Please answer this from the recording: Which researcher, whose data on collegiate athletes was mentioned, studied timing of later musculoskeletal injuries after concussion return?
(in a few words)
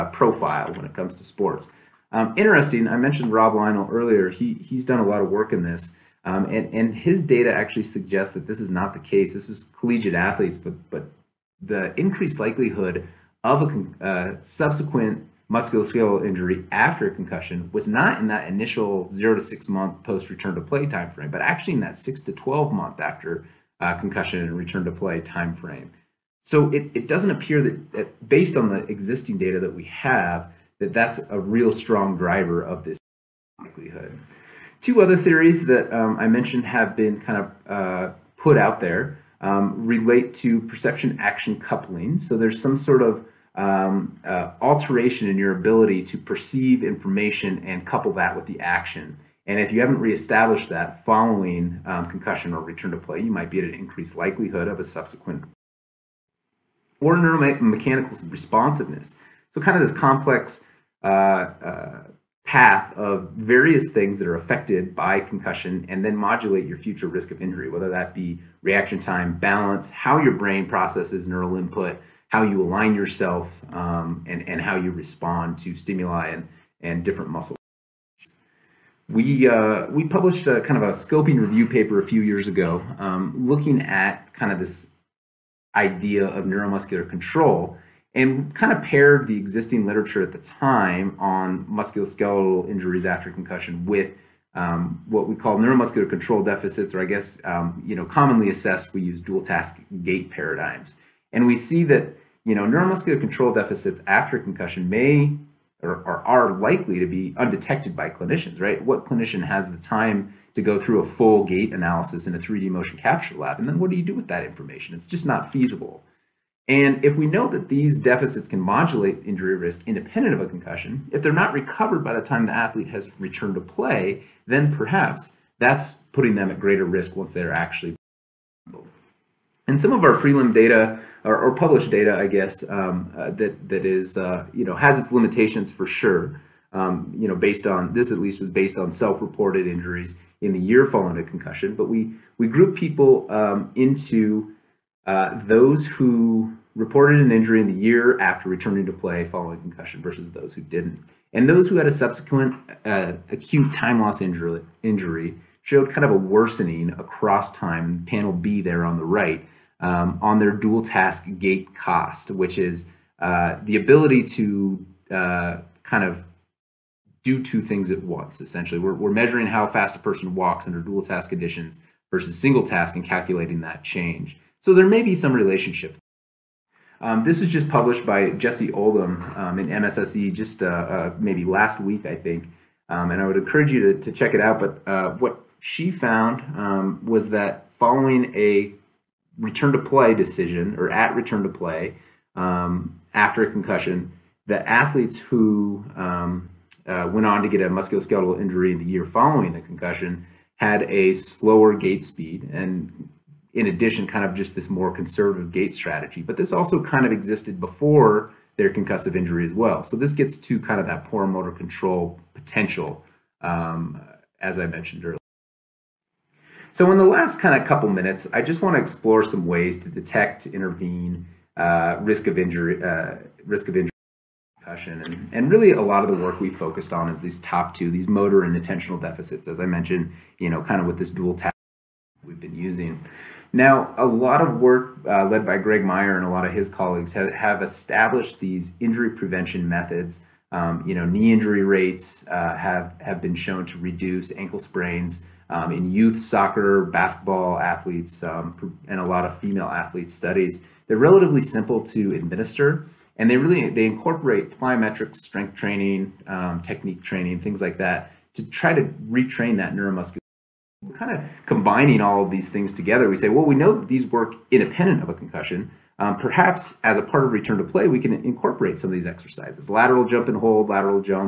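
Rob Lynall.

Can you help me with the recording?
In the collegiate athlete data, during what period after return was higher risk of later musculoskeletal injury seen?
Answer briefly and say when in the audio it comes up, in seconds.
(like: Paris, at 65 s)
6 to 12 months, at 21 s.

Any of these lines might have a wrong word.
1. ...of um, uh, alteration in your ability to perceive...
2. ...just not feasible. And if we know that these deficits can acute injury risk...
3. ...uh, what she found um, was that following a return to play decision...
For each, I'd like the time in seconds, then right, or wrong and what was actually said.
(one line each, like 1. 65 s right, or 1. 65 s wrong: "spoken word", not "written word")
1. 43 s right
2. 115 s wrong: "modulate", not "acute"
3. 184 s right.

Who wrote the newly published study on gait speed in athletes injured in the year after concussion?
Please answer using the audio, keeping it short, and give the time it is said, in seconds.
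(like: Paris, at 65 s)
Jessie Oldham, at 178 s.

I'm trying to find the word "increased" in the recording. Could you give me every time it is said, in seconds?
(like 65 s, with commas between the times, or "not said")
11 s, 53 s.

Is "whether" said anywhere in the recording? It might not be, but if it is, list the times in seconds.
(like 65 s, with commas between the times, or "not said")
67 s.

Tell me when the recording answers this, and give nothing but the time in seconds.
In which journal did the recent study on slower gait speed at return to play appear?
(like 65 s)
179 s.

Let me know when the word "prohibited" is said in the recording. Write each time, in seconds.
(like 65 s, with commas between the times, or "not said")
not said.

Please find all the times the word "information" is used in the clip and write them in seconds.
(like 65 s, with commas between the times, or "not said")
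46 s, 114 s.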